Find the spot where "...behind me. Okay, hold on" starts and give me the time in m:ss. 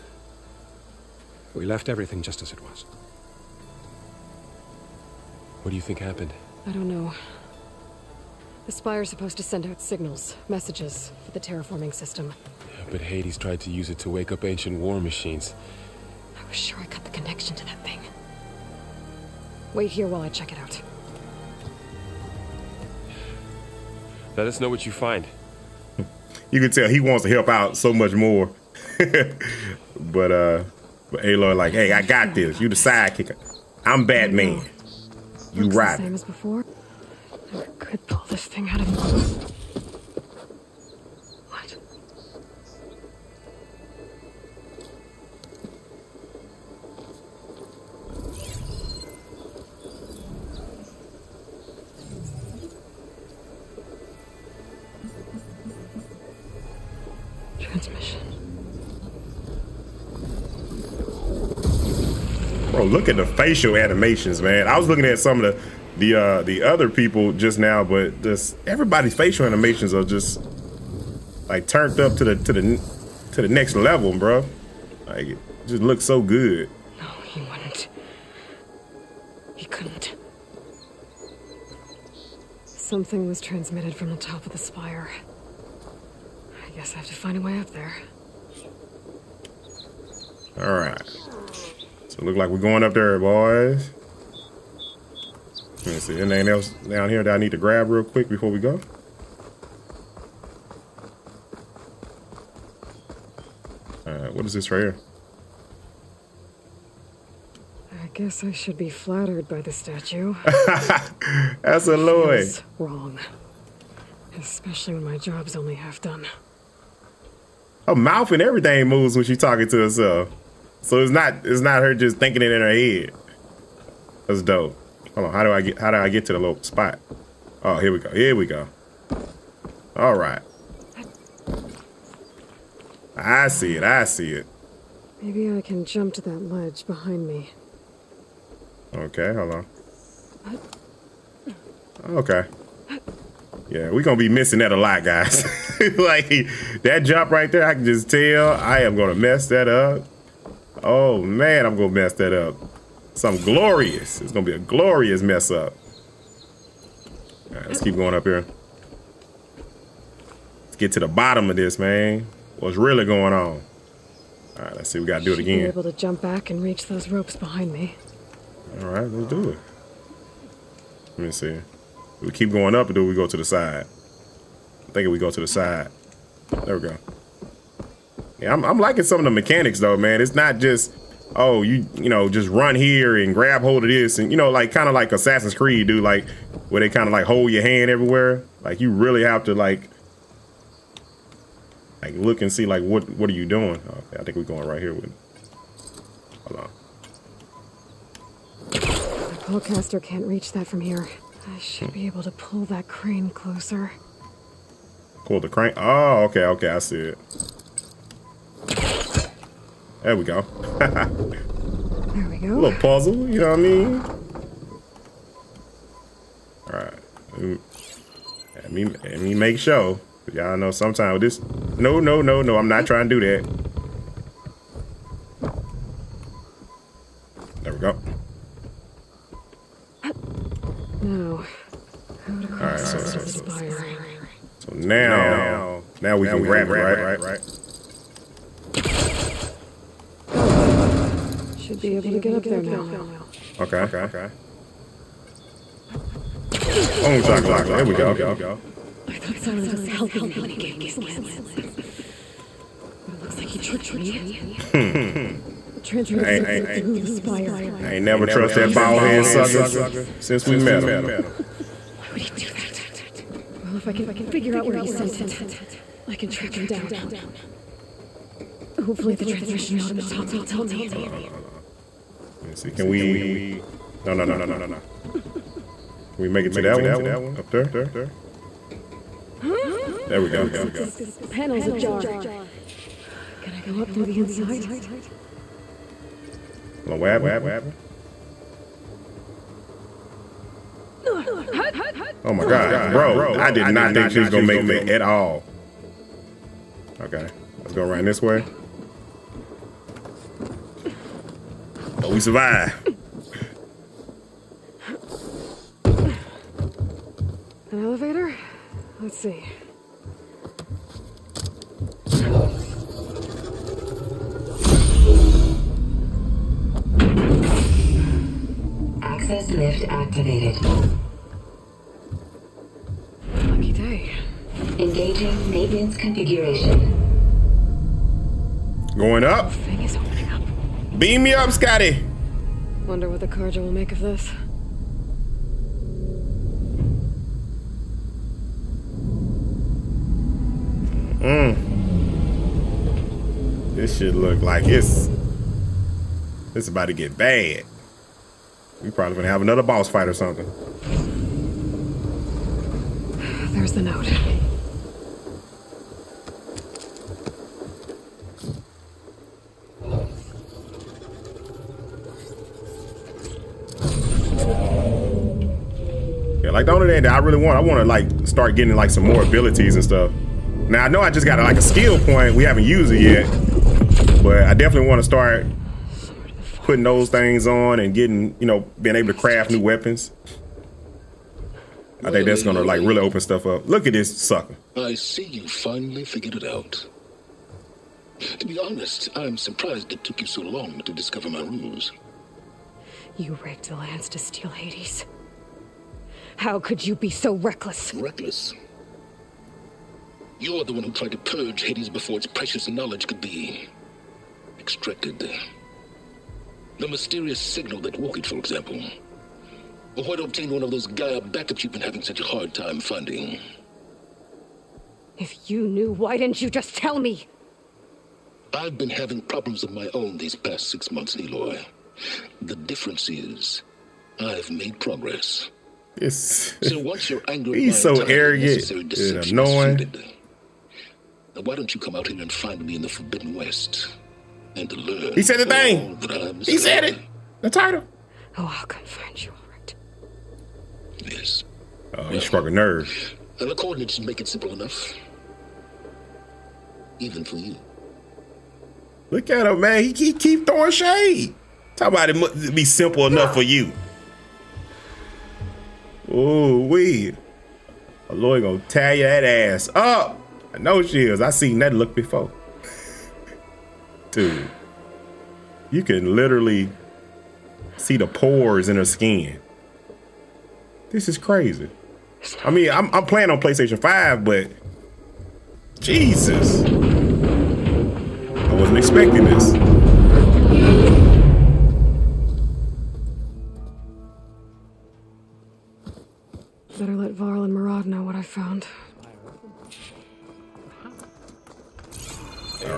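2:16.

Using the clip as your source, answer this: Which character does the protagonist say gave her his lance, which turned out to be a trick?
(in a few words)
Sylens.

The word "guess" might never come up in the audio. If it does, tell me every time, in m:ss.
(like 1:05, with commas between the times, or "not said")
1:26, 1:48.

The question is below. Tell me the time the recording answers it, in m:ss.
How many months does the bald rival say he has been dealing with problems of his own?
7:00.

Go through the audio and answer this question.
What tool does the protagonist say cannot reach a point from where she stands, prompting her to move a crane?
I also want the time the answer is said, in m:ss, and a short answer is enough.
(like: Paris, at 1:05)
Polecaster, at 3:19.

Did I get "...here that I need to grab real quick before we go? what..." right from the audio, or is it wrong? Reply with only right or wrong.
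right.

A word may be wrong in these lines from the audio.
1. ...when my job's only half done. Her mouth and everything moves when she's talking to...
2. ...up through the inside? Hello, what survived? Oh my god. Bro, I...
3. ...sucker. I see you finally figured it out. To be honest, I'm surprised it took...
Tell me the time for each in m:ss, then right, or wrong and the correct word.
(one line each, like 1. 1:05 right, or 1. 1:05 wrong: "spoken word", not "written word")
1. 1:54 right
2. 4:43 wrong: "happened", not "survived"
3. 6:24 right.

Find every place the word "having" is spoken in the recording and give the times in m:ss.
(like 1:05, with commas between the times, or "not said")
6:51, 6:58.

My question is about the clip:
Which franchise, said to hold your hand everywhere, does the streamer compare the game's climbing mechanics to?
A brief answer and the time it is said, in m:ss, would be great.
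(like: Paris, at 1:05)
Assassin's Creed, at 3:05.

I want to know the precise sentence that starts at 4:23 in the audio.
Well, if I can figure out where he sent it, I can track him down.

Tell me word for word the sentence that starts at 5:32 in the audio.
Wonder what the carja will make of this.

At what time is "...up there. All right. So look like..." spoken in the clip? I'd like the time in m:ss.
1:27.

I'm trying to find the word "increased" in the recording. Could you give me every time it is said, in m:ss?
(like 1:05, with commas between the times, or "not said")
not said.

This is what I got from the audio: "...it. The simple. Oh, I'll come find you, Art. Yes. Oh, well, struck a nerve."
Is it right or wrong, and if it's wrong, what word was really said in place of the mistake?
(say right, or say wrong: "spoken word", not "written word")
wrong: "title", not "simple".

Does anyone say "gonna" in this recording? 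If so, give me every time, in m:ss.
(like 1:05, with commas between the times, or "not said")
2:34, 5:49, 6:22, 7:38.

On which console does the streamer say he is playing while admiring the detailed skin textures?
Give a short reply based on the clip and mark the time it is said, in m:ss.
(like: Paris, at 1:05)
PlayStation 5, at 7:53.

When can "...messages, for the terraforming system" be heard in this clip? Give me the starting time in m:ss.
0:10.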